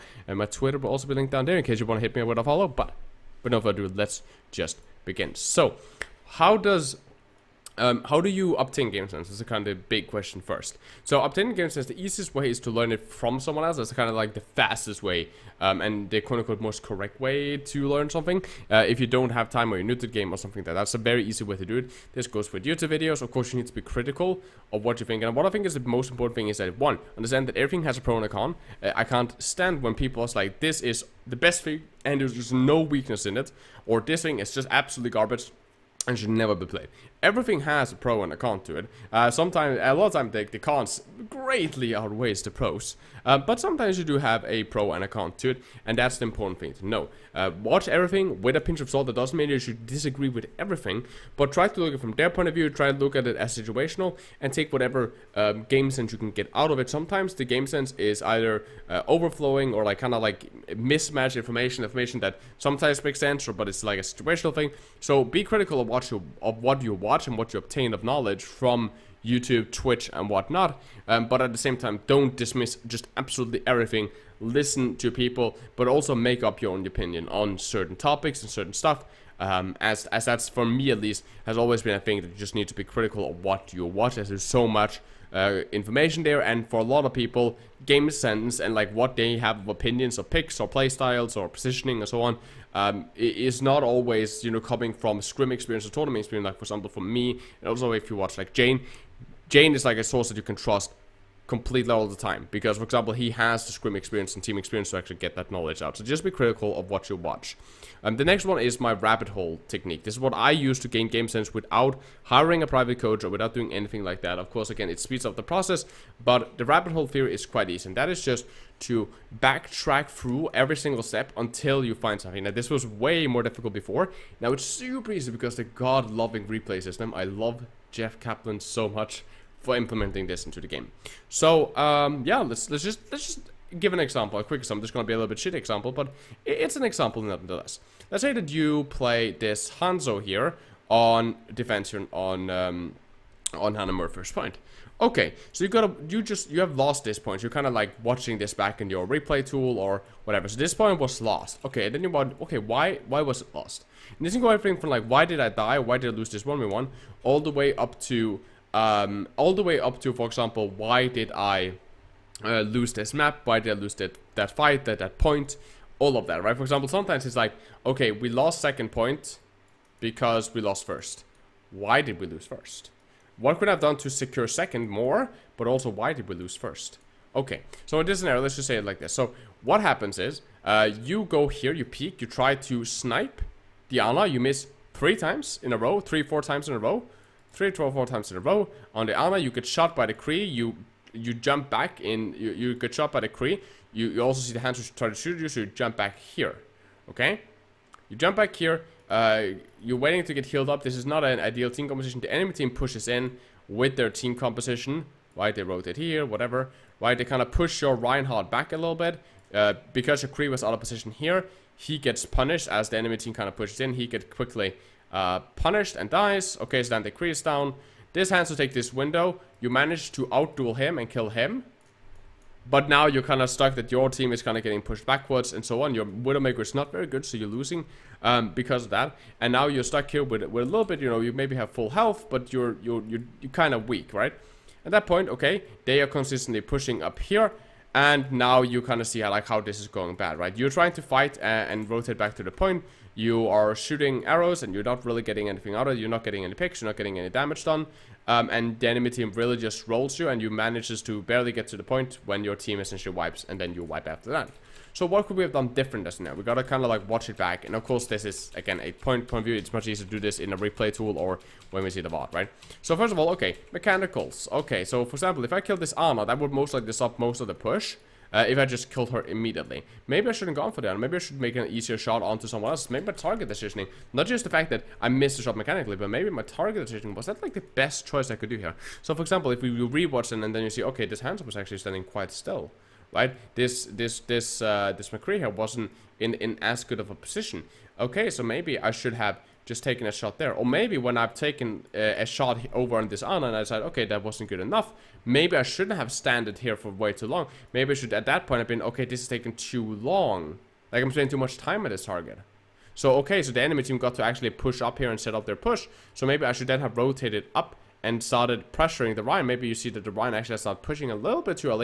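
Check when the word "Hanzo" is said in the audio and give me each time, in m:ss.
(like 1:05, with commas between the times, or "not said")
2:19, 4:41.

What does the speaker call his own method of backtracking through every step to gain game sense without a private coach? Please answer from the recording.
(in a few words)
rabbit hole technique.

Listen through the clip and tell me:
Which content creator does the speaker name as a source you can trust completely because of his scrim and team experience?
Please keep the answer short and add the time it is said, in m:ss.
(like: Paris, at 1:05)
Jayne, at 1:39.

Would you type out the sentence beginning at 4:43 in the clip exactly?
This this this uh, this McCree here wasn't in in as good of a position.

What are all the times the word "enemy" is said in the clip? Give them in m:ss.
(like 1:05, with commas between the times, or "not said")
3:22, 3:32, 4:08, 5:03.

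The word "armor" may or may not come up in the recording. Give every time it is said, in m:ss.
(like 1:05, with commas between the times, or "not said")
3:09, 4:25.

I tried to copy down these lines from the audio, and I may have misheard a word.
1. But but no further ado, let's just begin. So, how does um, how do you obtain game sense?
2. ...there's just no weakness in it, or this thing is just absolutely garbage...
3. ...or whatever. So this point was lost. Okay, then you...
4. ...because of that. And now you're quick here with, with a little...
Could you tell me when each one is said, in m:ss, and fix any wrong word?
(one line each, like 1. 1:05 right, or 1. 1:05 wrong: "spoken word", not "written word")
1. 0:02 right
2. 0:32 right
3. 2:29 right
4. 3:48 wrong: "stuck", not "quick".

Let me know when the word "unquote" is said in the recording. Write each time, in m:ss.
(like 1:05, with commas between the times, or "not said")
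0:16.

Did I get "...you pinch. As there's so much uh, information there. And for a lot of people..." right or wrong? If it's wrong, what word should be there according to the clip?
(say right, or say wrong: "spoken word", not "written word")
wrong: "watch", not "pinch".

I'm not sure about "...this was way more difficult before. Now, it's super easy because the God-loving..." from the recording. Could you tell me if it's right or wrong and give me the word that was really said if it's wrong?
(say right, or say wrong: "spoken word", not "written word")
right.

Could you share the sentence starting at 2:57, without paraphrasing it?
Okay, so in this scenario, let's just say it like this.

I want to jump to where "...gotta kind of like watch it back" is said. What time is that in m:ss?
4:16.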